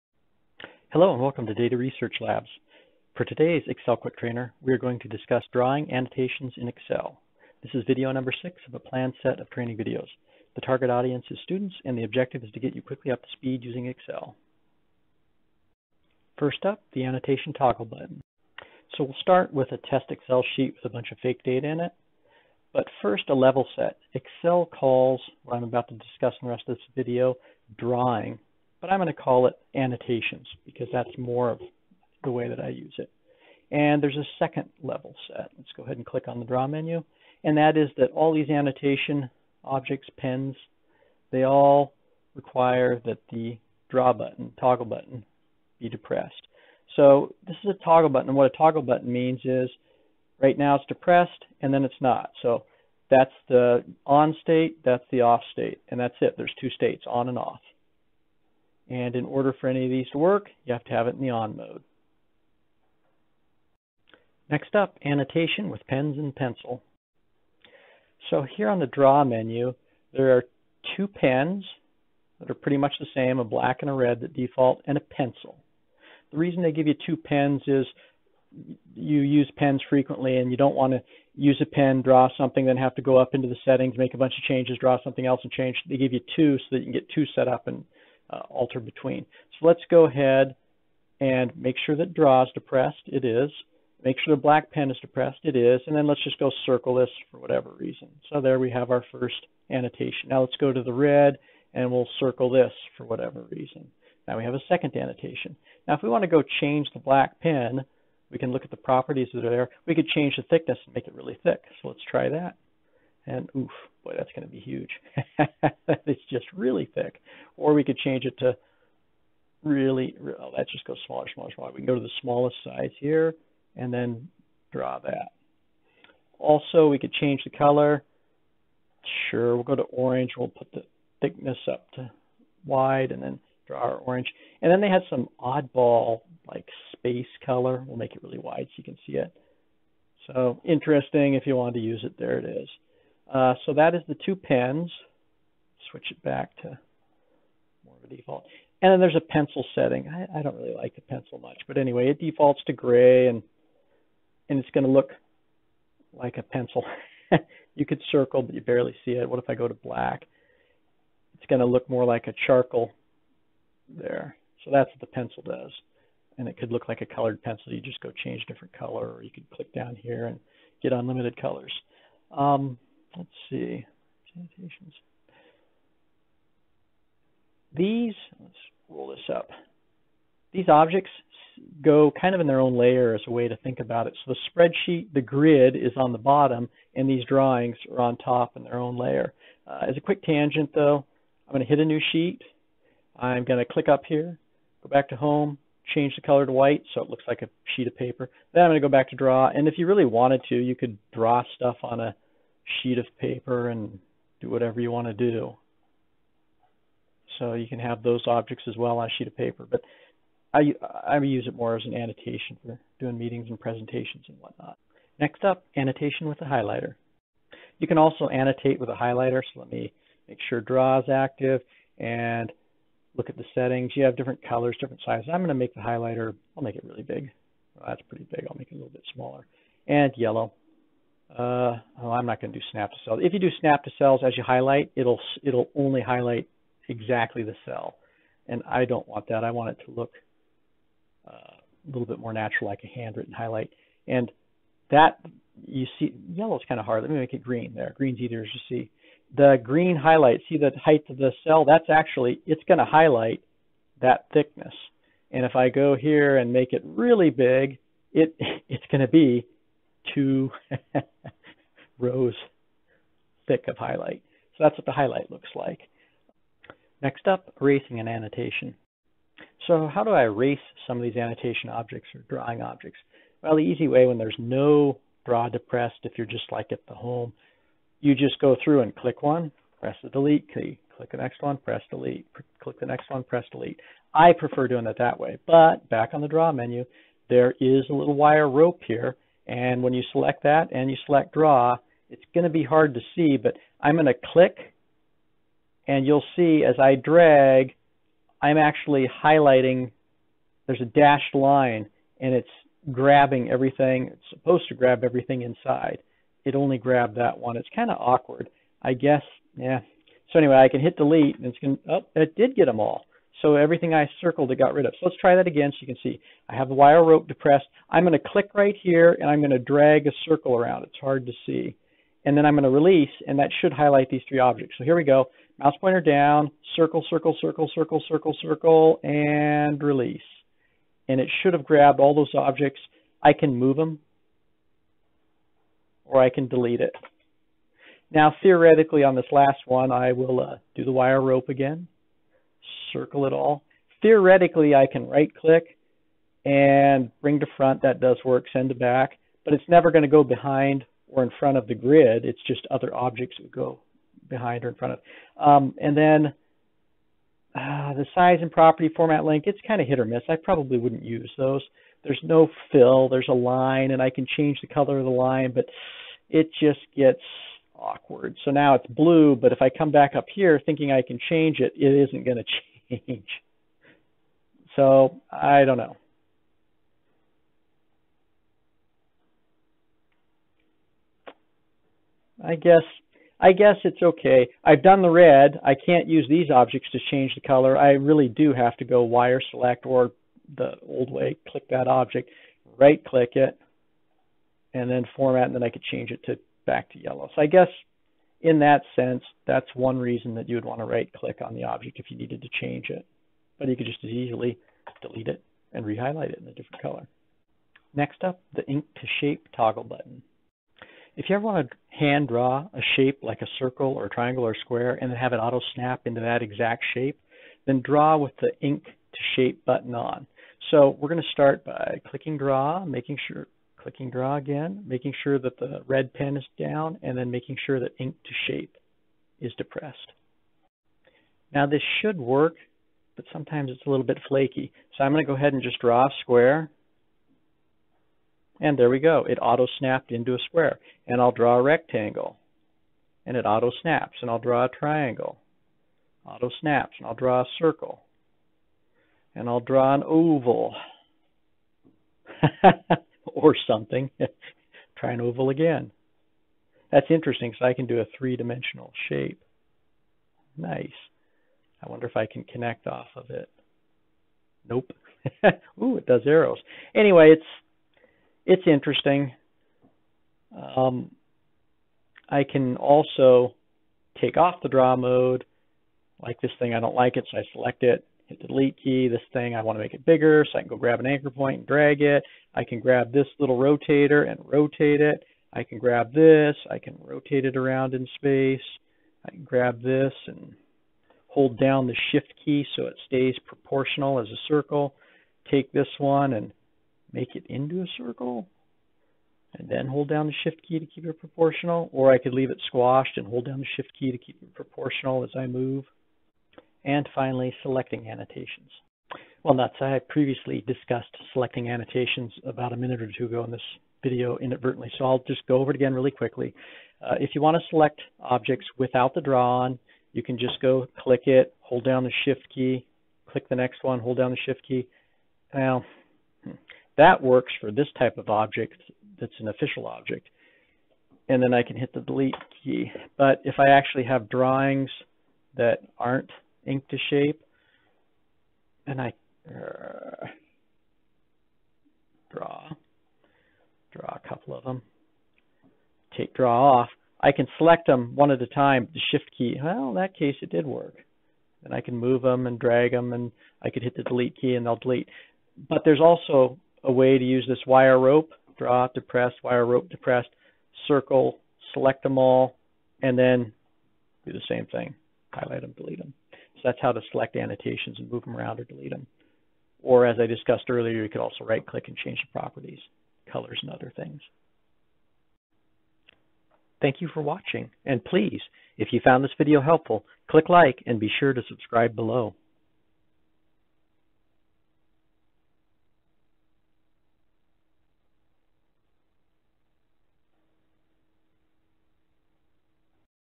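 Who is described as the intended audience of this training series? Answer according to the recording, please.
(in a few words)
students.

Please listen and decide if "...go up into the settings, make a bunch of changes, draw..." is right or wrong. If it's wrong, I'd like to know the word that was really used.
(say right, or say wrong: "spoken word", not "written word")
right.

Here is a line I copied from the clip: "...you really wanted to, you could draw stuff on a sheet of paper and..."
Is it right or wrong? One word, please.
right.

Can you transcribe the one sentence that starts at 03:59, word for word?
I want it to look uh, a little bit more natural, like a handwritten highlight.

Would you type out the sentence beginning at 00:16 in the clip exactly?
First up, the annotation toggle button.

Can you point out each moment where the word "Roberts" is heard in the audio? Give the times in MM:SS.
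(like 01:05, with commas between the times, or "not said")
not said.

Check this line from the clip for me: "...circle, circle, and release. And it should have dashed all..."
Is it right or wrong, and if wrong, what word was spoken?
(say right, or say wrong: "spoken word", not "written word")
wrong: "grabbed", not "dashed".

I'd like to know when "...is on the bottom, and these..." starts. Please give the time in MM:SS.
03:05.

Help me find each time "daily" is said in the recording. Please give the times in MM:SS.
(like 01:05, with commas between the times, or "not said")
not said.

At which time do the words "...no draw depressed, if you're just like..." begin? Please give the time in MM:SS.
04:34.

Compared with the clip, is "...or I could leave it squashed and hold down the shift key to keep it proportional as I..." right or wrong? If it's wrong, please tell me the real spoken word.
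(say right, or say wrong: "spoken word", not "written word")
right.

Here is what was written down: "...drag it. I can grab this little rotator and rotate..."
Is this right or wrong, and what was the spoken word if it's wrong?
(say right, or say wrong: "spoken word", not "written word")
right.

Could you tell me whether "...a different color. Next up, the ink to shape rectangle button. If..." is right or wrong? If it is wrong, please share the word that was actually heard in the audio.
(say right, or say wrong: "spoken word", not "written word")
wrong: "toggle", not "rectangle".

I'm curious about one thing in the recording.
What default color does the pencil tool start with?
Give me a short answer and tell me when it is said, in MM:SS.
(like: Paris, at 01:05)
gray, at 02:32.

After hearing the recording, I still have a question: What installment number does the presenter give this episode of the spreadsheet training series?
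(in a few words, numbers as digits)
6.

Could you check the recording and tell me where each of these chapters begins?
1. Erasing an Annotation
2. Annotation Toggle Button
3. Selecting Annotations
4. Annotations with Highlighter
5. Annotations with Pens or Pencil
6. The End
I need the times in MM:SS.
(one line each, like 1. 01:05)
1. 04:26
2. 00:15
3. 08:26
4. 03:34
5. 01:04
6. 09:35.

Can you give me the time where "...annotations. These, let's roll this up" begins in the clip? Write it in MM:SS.
02:54.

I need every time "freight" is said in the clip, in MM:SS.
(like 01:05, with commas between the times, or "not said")
not said.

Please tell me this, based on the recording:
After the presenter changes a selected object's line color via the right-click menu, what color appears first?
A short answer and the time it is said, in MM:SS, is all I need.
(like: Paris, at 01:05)
blue, at 06:08.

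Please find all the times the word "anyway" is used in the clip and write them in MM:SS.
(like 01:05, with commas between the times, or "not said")
02:31, 05:10, 07:46.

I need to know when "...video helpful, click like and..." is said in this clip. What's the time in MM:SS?
09:39.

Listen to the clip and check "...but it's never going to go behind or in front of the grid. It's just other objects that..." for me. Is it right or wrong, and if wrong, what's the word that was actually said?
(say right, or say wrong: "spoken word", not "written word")
right.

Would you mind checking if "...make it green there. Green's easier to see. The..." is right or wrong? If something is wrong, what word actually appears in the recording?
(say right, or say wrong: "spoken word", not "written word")
right.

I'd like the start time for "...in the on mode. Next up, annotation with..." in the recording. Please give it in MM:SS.
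01:01.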